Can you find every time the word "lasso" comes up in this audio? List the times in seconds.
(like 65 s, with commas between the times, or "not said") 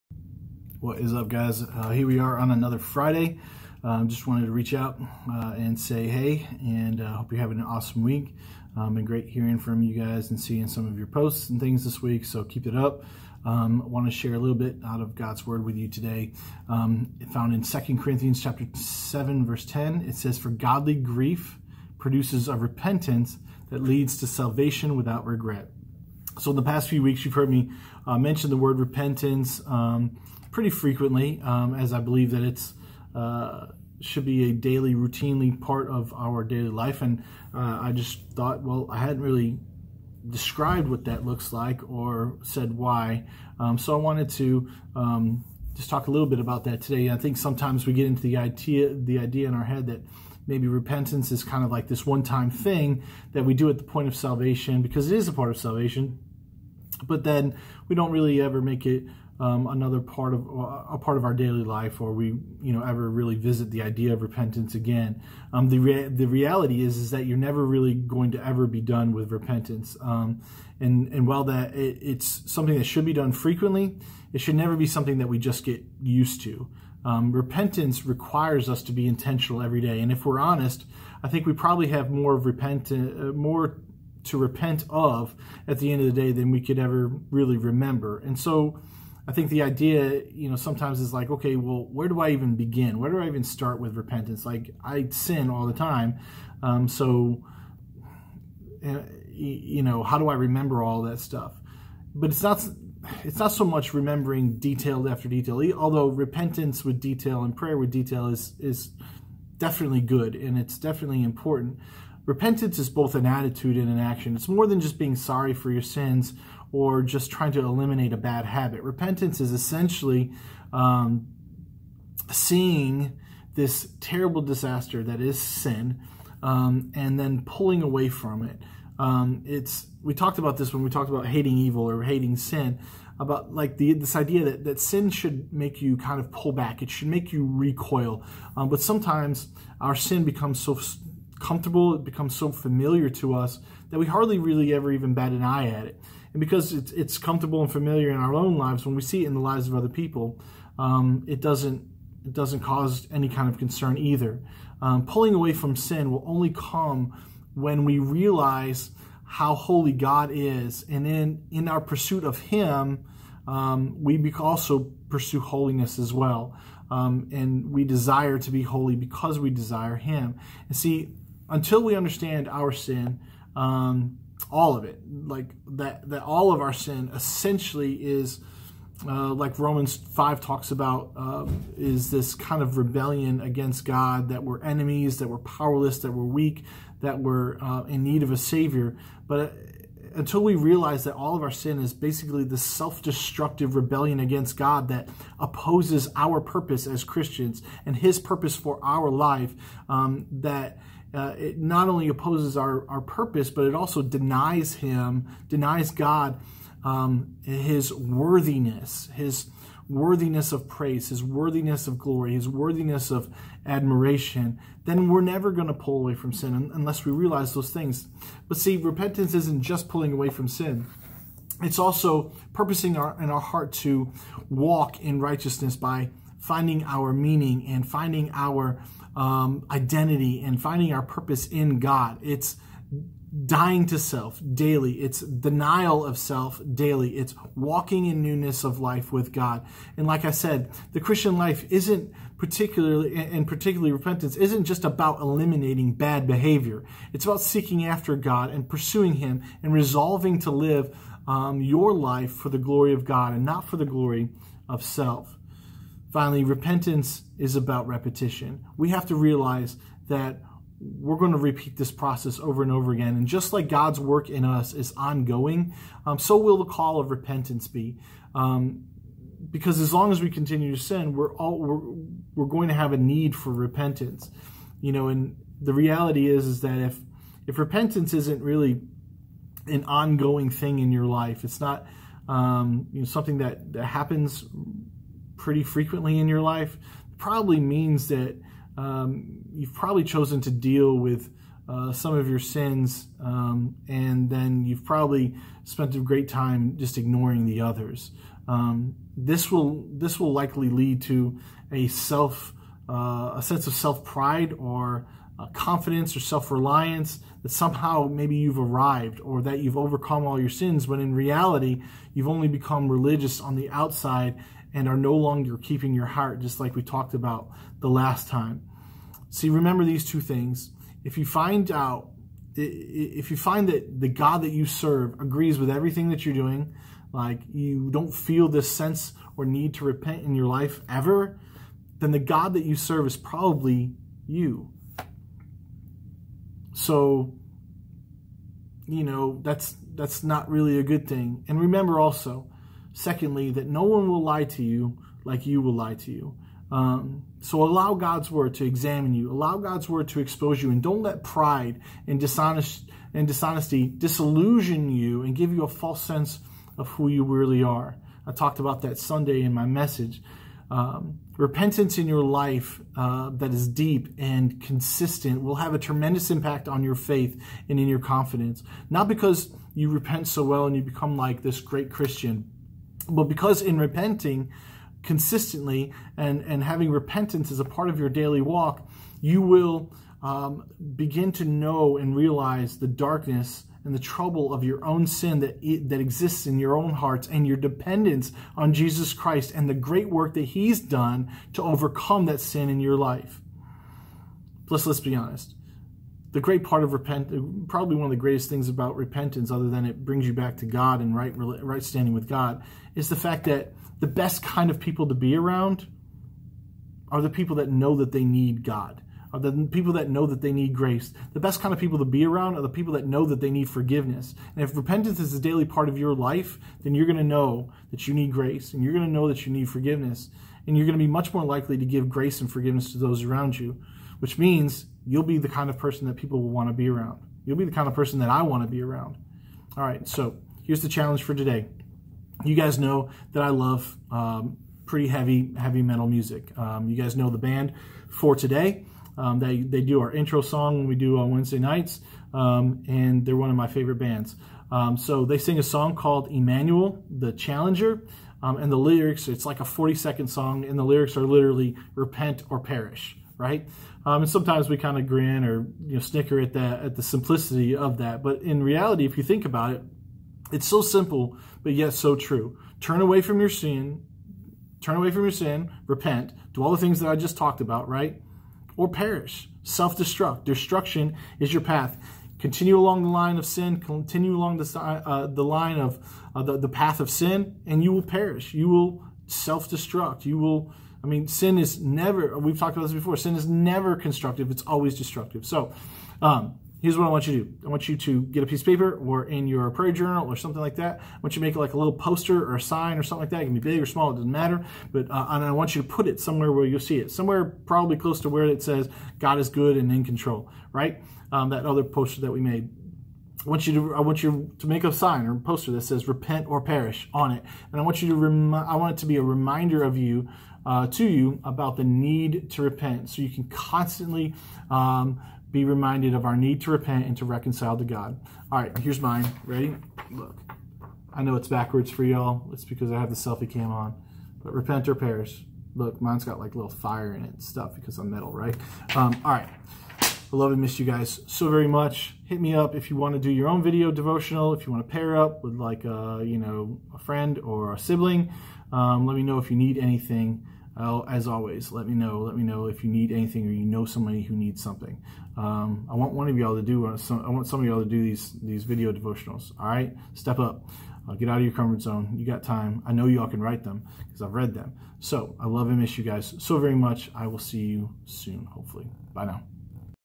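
not said.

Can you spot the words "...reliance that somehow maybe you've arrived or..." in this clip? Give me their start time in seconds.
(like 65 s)
306 s.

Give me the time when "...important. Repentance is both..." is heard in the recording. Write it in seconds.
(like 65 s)
111 s.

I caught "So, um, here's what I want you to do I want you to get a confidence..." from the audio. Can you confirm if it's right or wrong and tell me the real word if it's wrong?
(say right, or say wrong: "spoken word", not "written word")
wrong: "piece", not "confidence".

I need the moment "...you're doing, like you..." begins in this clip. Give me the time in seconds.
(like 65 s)
326 s.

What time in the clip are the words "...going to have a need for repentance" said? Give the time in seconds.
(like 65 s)
272 s.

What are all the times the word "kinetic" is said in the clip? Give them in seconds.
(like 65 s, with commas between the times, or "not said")
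not said.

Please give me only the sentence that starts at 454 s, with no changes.
Um, and sometimes we kind of grin or you know snicker at that at the simplicity of that.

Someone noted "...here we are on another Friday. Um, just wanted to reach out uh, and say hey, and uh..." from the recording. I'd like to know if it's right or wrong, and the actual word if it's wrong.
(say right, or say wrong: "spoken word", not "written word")
right.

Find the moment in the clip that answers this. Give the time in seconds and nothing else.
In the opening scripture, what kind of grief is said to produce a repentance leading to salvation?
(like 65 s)
20 s.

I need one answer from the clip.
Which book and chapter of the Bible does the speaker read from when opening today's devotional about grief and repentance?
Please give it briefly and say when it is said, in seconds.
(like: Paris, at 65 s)
Second Corinthians 7, at 17 s.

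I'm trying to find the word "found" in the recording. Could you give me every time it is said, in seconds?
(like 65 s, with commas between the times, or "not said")
17 s.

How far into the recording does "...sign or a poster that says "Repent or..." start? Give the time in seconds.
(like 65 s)
504 s.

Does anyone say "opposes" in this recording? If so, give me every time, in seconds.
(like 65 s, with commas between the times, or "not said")
195 s, 202 s.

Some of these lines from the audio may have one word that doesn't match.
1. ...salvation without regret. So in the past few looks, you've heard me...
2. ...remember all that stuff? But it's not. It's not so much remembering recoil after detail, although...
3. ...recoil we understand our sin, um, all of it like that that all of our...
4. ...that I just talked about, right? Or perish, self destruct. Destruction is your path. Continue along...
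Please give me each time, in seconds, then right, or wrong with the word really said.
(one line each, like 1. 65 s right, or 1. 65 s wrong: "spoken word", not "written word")
1. 24 s wrong: "weeks", not "looks"
2. 100 s wrong: "detail", not "recoil"
3. 171 s wrong: "until", not "recoil"
4. 467 s right.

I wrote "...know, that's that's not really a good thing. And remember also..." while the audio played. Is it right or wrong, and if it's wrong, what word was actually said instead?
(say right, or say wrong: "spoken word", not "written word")
right.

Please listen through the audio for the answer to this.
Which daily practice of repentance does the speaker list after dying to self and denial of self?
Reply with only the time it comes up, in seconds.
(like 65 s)
238 s.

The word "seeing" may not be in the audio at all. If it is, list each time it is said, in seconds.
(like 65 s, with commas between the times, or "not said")
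10 s, 122 s.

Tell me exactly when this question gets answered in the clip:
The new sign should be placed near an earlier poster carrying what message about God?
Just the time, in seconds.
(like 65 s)
499 s.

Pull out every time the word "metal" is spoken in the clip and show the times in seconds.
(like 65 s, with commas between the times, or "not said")
435 s, 528 s.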